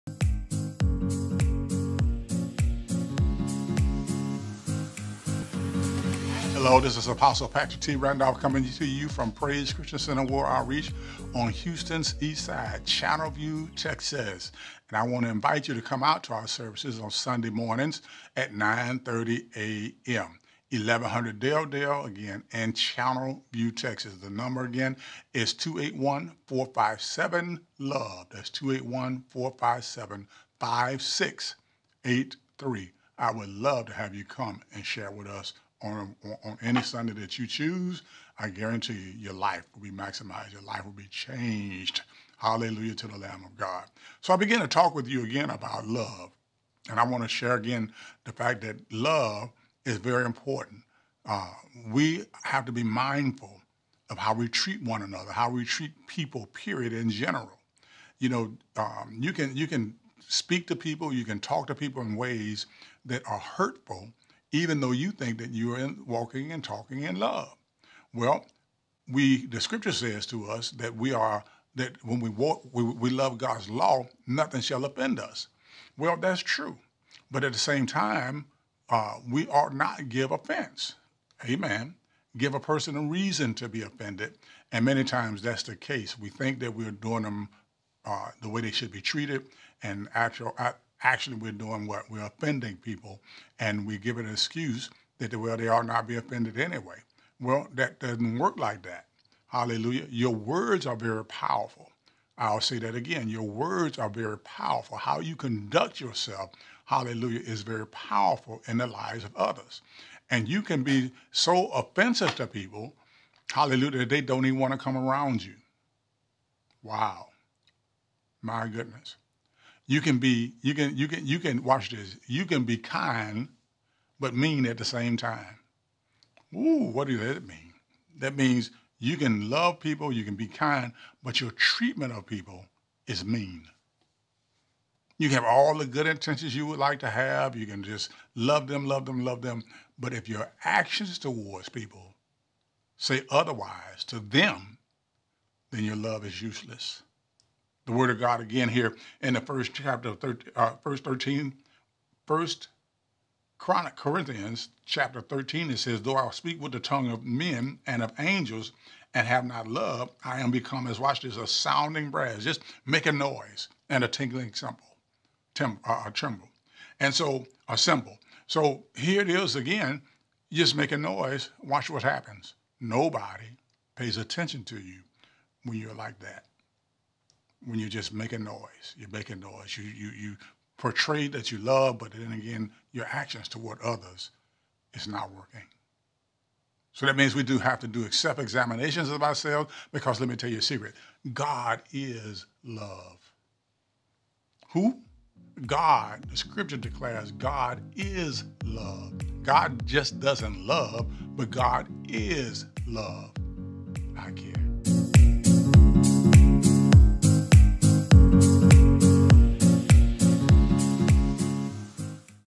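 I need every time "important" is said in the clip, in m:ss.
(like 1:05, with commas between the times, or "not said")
0:50.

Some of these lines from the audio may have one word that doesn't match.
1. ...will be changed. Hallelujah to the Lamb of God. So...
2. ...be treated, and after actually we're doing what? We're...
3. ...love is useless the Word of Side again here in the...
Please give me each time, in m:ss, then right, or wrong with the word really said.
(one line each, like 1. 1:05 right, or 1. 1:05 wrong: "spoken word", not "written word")
1. 0:40 right
2. 1:28 right
3. 2:25 wrong: "God", not "Side".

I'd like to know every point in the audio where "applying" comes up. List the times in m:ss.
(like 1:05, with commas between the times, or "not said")
not said.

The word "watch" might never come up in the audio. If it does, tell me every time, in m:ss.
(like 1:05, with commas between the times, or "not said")
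2:01, 2:40, 2:51.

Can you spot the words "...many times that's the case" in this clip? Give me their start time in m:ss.
1:24.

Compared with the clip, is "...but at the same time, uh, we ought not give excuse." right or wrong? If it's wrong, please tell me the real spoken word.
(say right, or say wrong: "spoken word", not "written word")
wrong: "offense", not "excuse".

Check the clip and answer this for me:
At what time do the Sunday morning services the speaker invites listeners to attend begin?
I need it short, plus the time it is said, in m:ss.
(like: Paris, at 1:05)
9:30 a.m., at 0:18.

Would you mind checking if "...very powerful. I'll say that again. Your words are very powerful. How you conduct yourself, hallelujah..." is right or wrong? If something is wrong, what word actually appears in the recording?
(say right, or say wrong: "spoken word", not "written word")
right.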